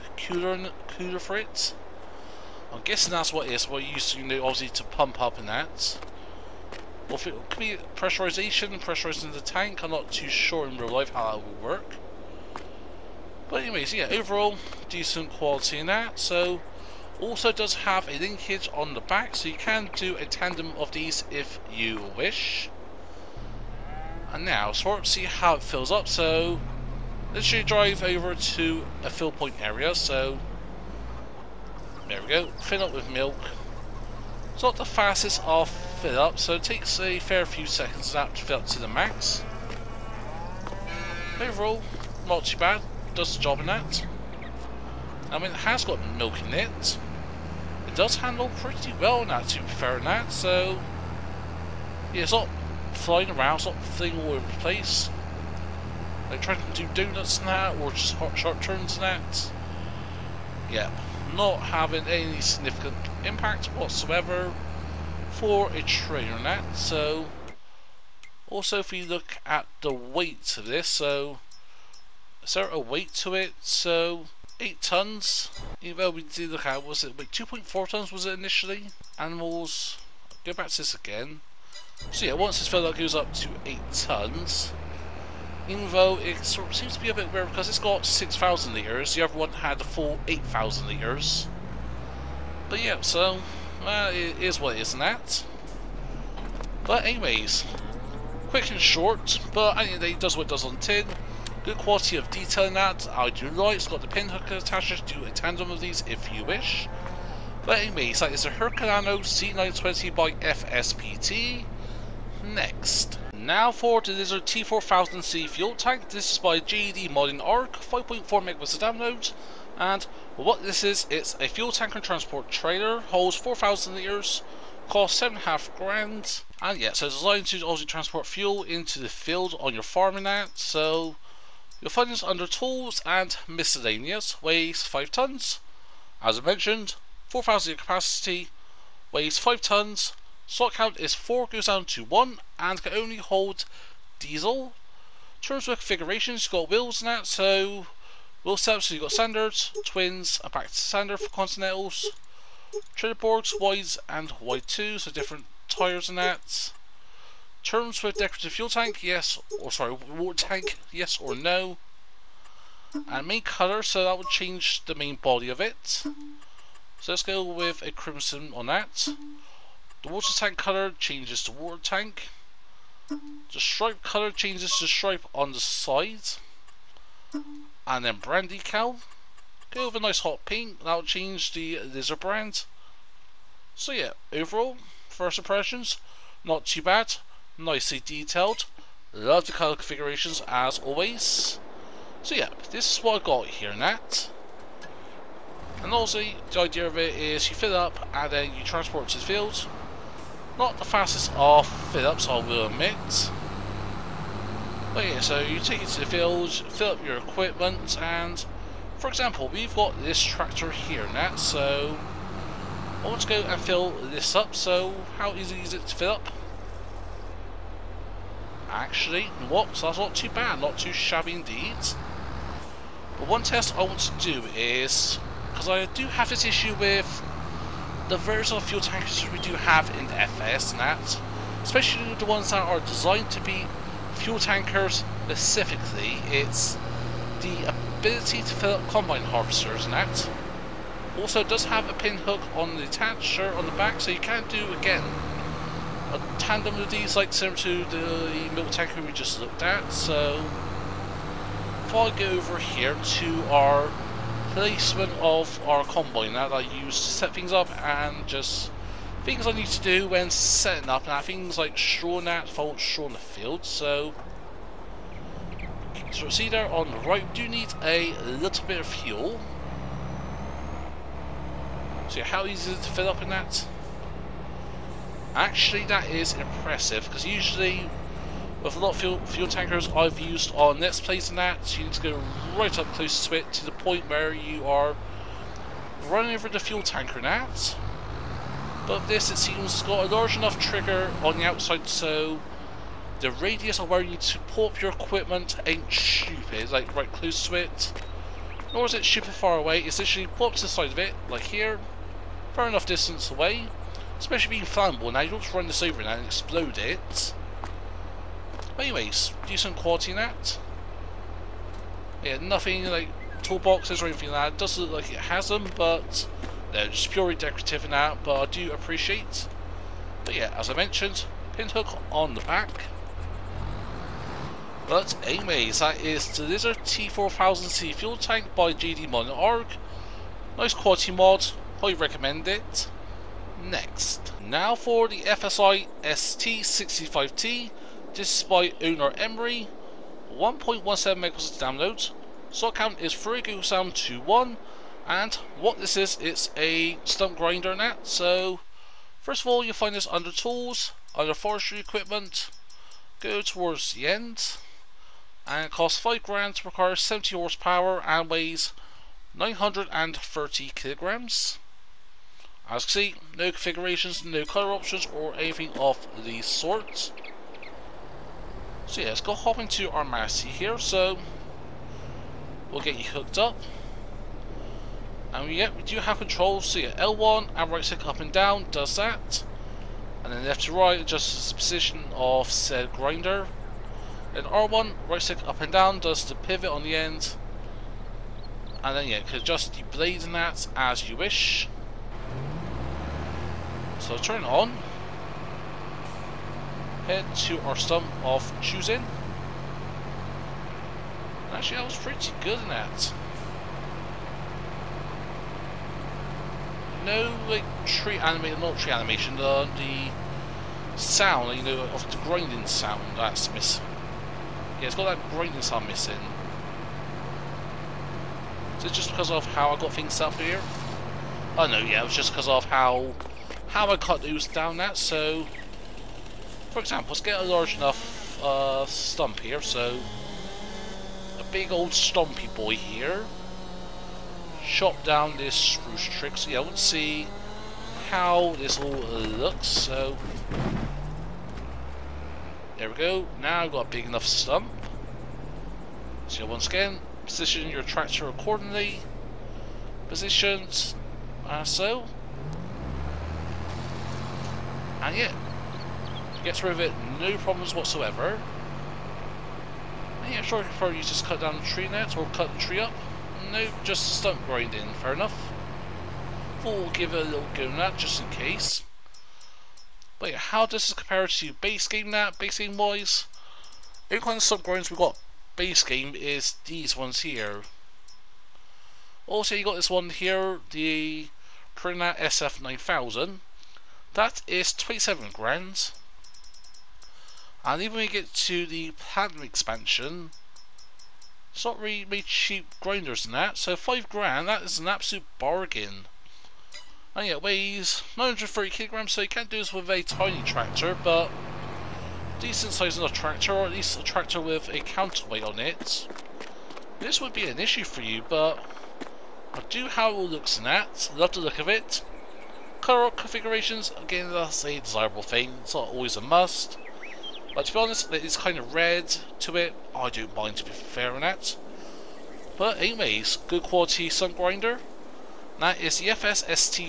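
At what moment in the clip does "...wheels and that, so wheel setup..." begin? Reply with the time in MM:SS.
02:26.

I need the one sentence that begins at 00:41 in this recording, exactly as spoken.
Overall, not too bad does the job in that.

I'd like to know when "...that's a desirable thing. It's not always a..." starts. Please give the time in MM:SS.
08:34.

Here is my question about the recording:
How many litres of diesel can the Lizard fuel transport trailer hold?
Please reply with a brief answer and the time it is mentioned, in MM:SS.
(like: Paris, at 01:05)
4,000 litres, at 02:02.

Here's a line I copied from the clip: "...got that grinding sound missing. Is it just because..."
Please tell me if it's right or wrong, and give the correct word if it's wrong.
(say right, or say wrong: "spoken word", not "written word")
right.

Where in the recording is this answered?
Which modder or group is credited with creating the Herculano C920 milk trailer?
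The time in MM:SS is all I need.
01:50.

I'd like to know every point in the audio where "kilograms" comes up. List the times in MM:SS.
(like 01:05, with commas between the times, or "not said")
06:00, 08:18.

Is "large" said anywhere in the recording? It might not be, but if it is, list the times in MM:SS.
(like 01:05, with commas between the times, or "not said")
04:50, 07:07.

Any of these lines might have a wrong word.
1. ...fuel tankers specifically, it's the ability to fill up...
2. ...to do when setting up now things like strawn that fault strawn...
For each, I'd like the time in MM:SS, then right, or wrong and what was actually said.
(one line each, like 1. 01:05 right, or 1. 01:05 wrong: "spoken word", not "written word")
1. 03:54 right
2. 04:19 right.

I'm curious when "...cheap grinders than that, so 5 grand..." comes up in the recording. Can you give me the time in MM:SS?
08:12.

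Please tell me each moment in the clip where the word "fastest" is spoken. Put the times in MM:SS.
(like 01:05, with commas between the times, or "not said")
00:34, 03:20.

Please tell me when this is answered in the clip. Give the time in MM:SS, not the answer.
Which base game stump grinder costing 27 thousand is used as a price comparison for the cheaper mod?
08:01.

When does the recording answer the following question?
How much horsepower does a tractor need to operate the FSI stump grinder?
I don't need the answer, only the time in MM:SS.
05:57.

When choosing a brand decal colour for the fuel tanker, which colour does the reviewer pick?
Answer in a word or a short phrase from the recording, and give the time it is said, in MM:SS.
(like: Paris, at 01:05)
Hot pink, at 03:00.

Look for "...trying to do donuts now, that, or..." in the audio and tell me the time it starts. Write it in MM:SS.
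00:56.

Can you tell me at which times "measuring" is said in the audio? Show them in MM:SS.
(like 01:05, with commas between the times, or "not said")
not said.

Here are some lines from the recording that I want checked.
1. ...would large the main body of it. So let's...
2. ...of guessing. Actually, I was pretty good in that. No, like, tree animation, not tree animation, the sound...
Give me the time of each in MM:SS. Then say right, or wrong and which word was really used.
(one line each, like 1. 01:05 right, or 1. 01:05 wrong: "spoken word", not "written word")
1. 02:44 wrong: "change", not "large"
2. 06:38 wrong: "choosing", not "guessing".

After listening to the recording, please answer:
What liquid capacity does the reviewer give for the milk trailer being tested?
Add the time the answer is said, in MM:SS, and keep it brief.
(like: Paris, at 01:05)
6,000 litres, at 01:28.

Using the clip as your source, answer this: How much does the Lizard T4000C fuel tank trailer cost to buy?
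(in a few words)
7,500.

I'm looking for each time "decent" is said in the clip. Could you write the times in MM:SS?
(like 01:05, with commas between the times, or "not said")
00:14, 05:09, 08:22.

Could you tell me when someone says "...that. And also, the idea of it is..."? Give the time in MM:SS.
03:13.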